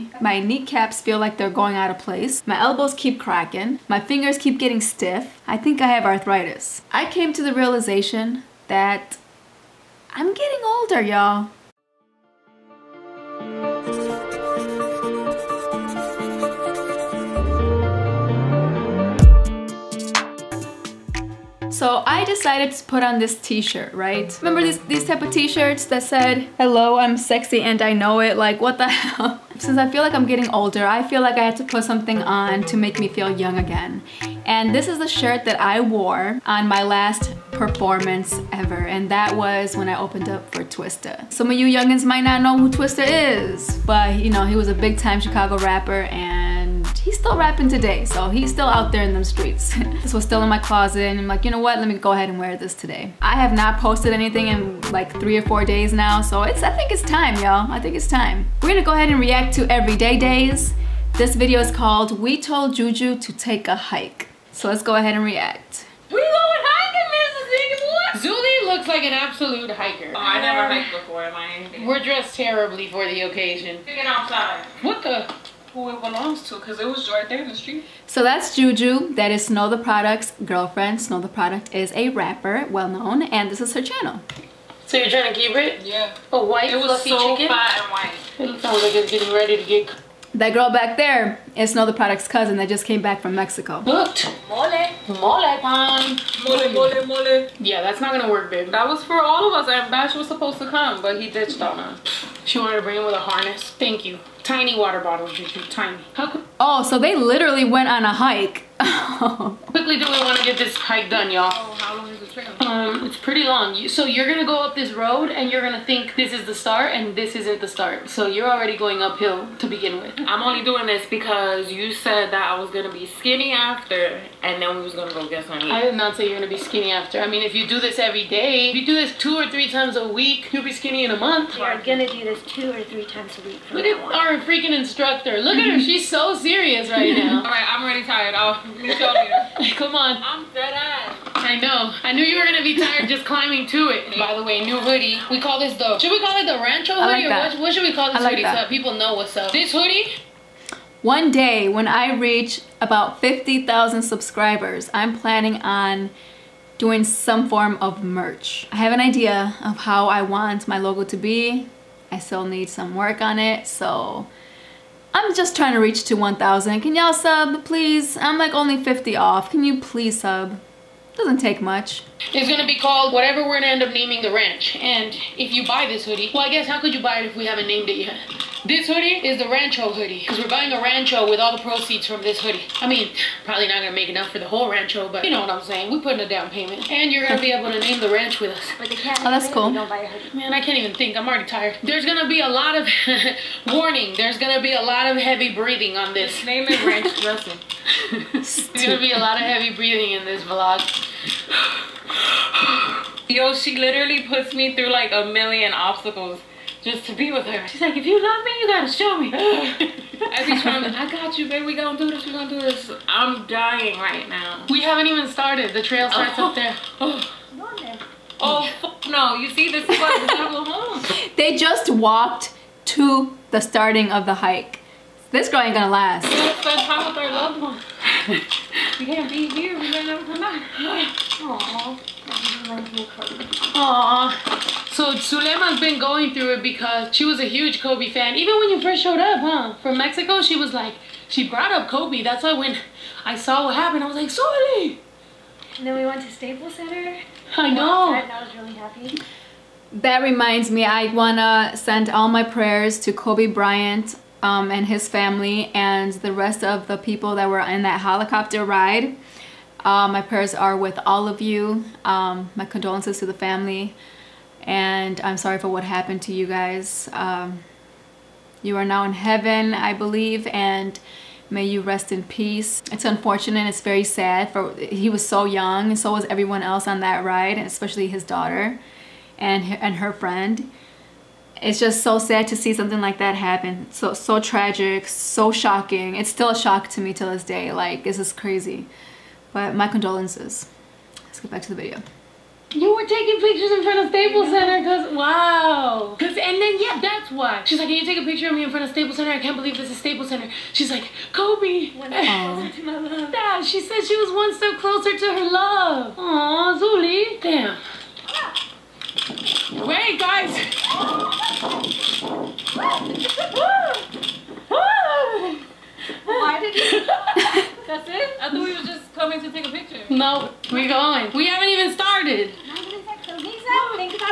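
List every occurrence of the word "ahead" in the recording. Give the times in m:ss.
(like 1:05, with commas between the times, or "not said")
0:52, 0:58, 1:04.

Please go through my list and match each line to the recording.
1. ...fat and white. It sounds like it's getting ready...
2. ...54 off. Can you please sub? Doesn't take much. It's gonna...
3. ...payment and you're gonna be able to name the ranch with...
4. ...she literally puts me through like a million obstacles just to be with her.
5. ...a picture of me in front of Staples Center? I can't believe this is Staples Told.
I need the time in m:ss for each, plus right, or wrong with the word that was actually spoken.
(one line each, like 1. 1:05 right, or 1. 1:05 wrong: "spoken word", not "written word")
1. 1:27 right
2. 2:48 wrong: "50", not "54"
3. 3:06 right
4. 3:23 right
5. 4:58 wrong: "Center", not "Told".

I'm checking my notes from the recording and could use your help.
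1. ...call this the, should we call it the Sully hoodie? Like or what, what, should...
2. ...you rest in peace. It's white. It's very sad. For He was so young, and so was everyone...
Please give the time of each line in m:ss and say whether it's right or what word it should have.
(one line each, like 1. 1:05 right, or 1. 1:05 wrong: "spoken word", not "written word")
1. 2:25 wrong: "Rancho", not "Sully"
2. 4:31 wrong: "unfortunate", not "white".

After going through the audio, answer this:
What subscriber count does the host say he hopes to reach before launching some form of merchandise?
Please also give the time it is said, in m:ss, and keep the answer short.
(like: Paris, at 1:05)
50,000, at 2:33.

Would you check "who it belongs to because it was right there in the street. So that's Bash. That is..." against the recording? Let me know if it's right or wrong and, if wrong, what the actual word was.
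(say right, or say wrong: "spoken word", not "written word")
wrong: "Juju", not "Bash".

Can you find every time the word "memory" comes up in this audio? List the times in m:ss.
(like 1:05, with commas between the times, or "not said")
not said.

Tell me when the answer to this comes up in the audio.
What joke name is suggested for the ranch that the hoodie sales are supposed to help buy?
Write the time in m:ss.
3:16.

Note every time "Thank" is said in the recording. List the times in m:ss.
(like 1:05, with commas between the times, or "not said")
1:43.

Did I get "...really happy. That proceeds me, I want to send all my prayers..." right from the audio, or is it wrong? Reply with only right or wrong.
wrong.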